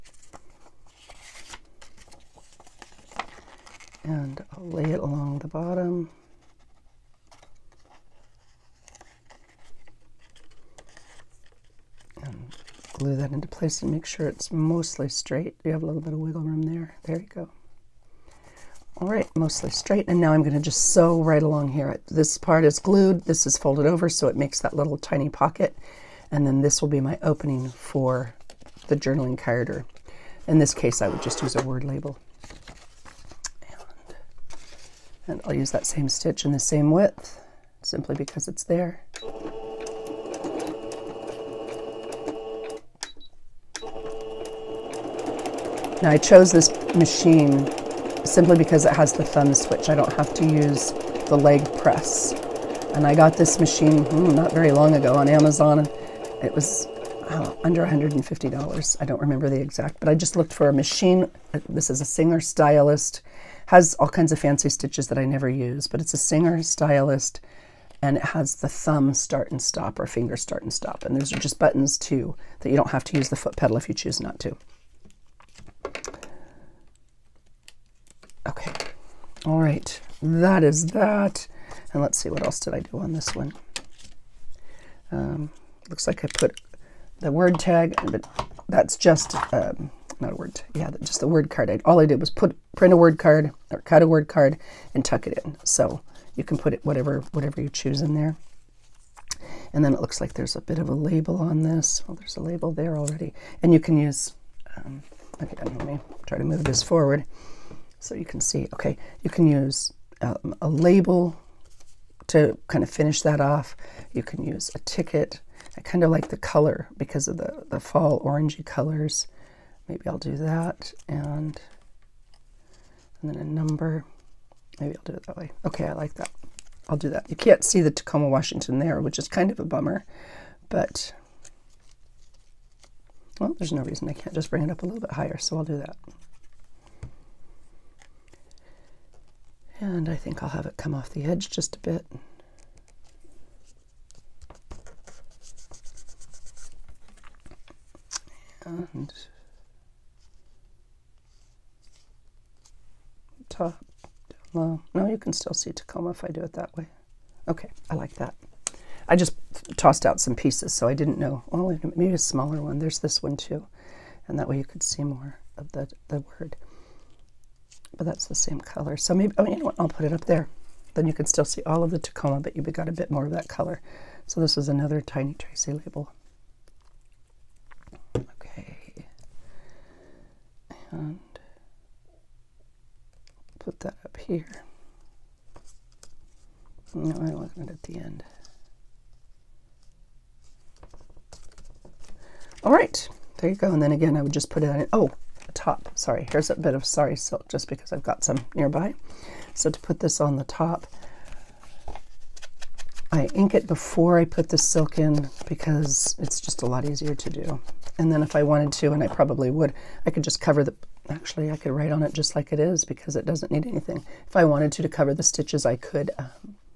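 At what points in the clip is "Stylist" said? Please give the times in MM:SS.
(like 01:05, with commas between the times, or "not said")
01:02, 01:06.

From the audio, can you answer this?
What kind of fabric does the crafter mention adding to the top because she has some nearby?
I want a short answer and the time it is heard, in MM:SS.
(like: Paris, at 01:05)
sari silk, at 03:16.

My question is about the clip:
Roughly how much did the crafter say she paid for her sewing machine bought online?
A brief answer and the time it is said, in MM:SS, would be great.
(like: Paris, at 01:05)
under $150, at 00:57.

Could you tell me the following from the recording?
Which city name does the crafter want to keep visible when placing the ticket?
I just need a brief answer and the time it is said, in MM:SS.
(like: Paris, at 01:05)
Tacoma, Washington, at 02:07.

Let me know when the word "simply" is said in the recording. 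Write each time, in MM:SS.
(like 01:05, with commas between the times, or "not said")
00:37, 00:48.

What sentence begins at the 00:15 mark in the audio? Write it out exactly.
You have a little bit of wiggle room there.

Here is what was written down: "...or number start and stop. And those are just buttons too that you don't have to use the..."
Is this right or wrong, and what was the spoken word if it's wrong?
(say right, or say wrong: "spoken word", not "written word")
wrong: "finger", not "number".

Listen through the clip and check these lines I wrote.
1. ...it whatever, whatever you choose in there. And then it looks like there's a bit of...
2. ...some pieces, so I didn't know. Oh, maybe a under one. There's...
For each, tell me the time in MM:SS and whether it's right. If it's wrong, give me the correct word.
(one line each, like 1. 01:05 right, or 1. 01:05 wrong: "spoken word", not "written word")
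1. 01:36 right
2. 02:40 wrong: "smaller", not "under".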